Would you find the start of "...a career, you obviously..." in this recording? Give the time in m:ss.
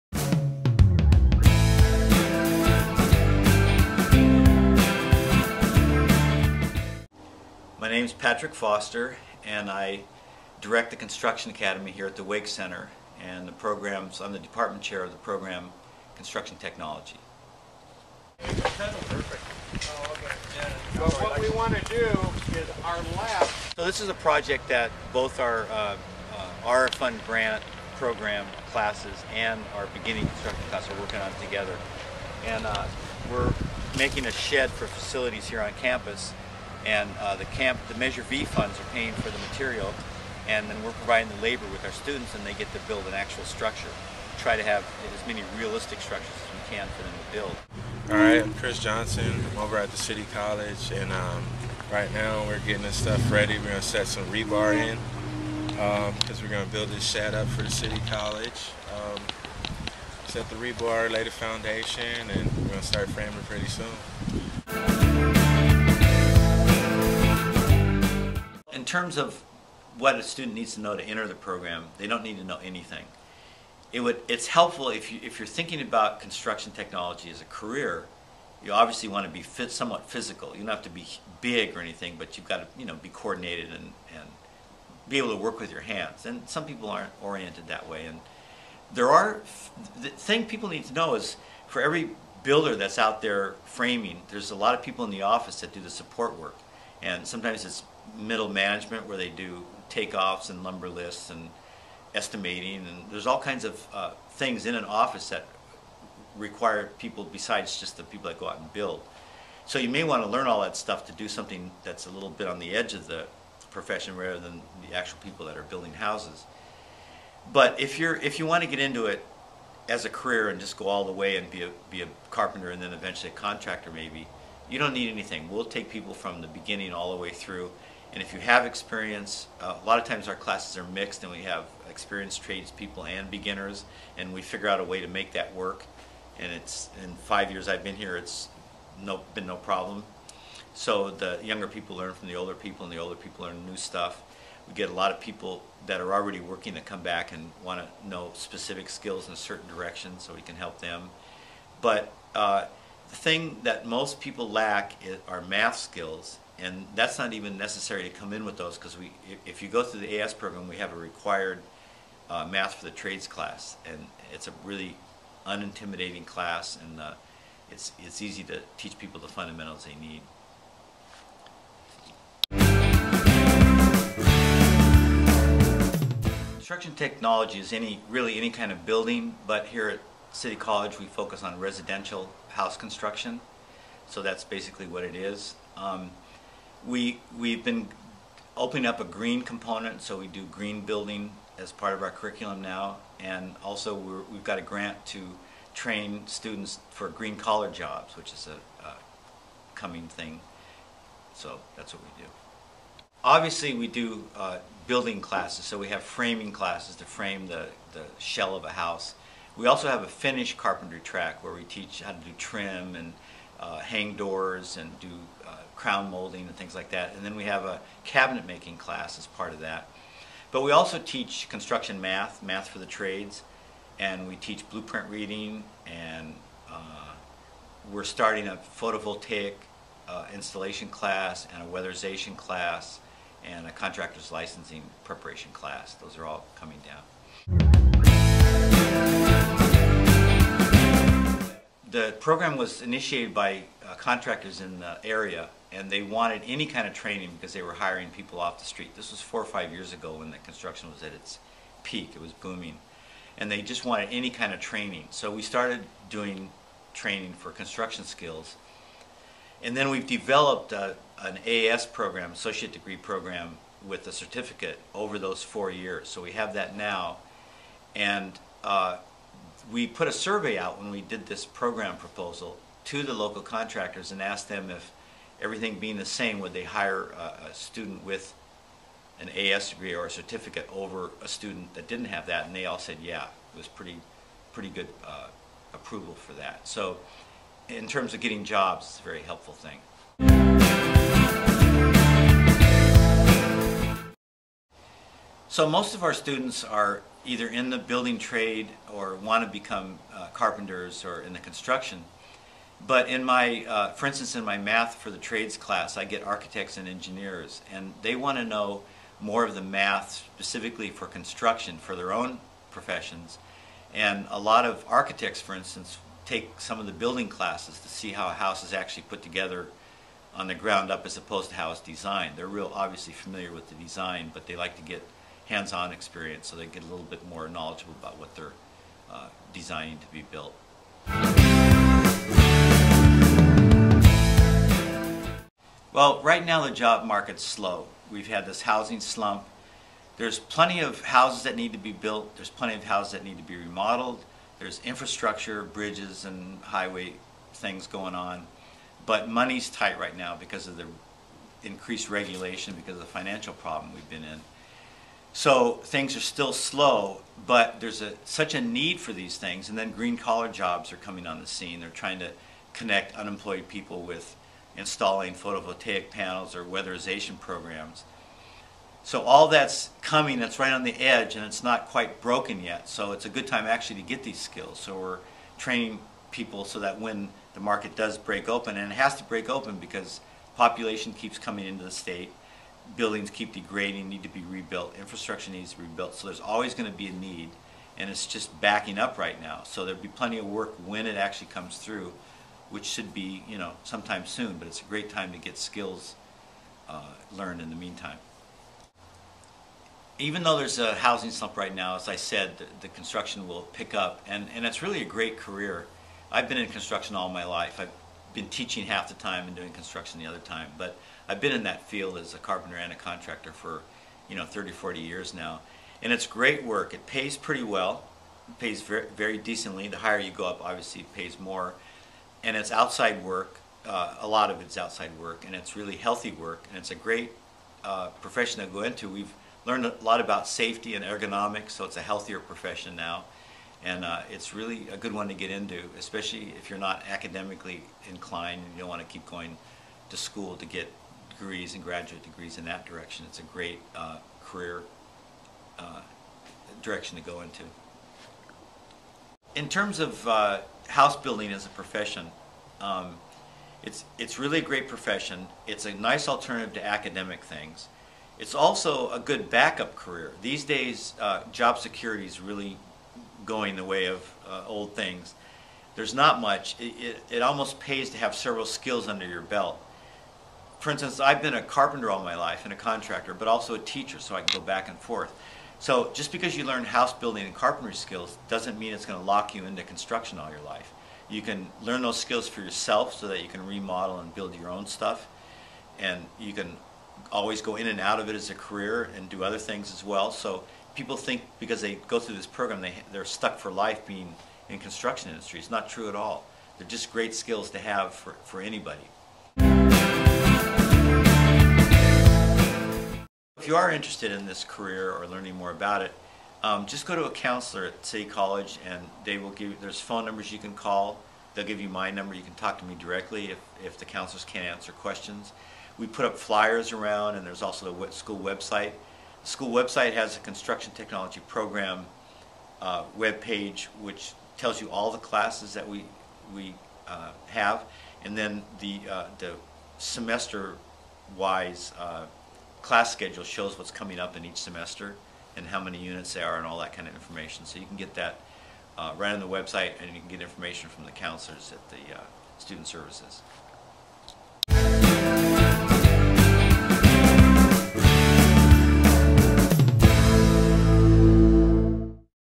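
1:17.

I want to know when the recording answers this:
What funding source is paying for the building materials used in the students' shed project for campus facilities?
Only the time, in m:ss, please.
0:37.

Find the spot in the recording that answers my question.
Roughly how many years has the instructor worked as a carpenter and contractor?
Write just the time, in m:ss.
6:54.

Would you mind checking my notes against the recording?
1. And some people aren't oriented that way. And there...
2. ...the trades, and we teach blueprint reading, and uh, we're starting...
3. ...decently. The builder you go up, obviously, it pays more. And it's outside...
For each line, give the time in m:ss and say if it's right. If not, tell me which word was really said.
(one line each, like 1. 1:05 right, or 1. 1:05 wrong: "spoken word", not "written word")
1. 1:26 right
2. 3:42 right
3. 6:59 wrong: "higher", not "builder".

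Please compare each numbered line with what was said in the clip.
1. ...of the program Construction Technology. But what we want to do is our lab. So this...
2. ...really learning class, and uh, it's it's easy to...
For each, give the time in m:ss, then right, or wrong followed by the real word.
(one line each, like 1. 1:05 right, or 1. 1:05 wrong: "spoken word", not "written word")
1. 0:15 right
2. 2:44 wrong: "unintimidating", not "learning".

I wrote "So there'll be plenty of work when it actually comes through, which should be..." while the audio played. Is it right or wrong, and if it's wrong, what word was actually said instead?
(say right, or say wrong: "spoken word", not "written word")
right.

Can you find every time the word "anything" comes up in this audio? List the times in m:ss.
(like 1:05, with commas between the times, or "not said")
1:12, 1:21, 2:05.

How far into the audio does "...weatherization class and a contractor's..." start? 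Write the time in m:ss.
3:51.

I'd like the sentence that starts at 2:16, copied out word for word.
And it's in five years I've been here, it's no, been no problem.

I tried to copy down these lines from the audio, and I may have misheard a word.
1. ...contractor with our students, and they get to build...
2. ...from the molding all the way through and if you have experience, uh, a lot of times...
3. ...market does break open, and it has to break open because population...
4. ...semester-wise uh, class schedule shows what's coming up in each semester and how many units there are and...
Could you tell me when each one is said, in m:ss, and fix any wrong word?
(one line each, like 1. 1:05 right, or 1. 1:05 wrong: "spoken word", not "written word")
1. 0:41 wrong: "labor", not "contractor"
2. 2:06 wrong: "beginning", not "molding"
3. 6:17 right
4. 8:49 right.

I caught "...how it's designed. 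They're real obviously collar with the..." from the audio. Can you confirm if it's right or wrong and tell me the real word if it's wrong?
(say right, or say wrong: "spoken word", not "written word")
wrong: "familiar", not "collar".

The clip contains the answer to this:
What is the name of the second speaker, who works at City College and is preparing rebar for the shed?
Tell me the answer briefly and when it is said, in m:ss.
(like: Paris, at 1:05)
Chris Johnson, at 0:48.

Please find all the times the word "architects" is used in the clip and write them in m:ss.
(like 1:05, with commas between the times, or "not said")
5:06, 5:14.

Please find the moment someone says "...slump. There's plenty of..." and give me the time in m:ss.
5:39.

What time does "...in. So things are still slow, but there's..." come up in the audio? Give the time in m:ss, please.
5:54.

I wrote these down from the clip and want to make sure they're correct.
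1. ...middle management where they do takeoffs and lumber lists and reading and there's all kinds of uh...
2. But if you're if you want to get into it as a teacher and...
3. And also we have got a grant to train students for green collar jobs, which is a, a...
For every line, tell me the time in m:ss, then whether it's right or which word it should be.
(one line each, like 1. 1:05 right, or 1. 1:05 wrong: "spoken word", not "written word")
1. 1:38 wrong: "estimating", not "reading"
2. 1:57 wrong: "career", not "teacher"
3. 3:13 right.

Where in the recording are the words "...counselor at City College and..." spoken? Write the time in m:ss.
8:27.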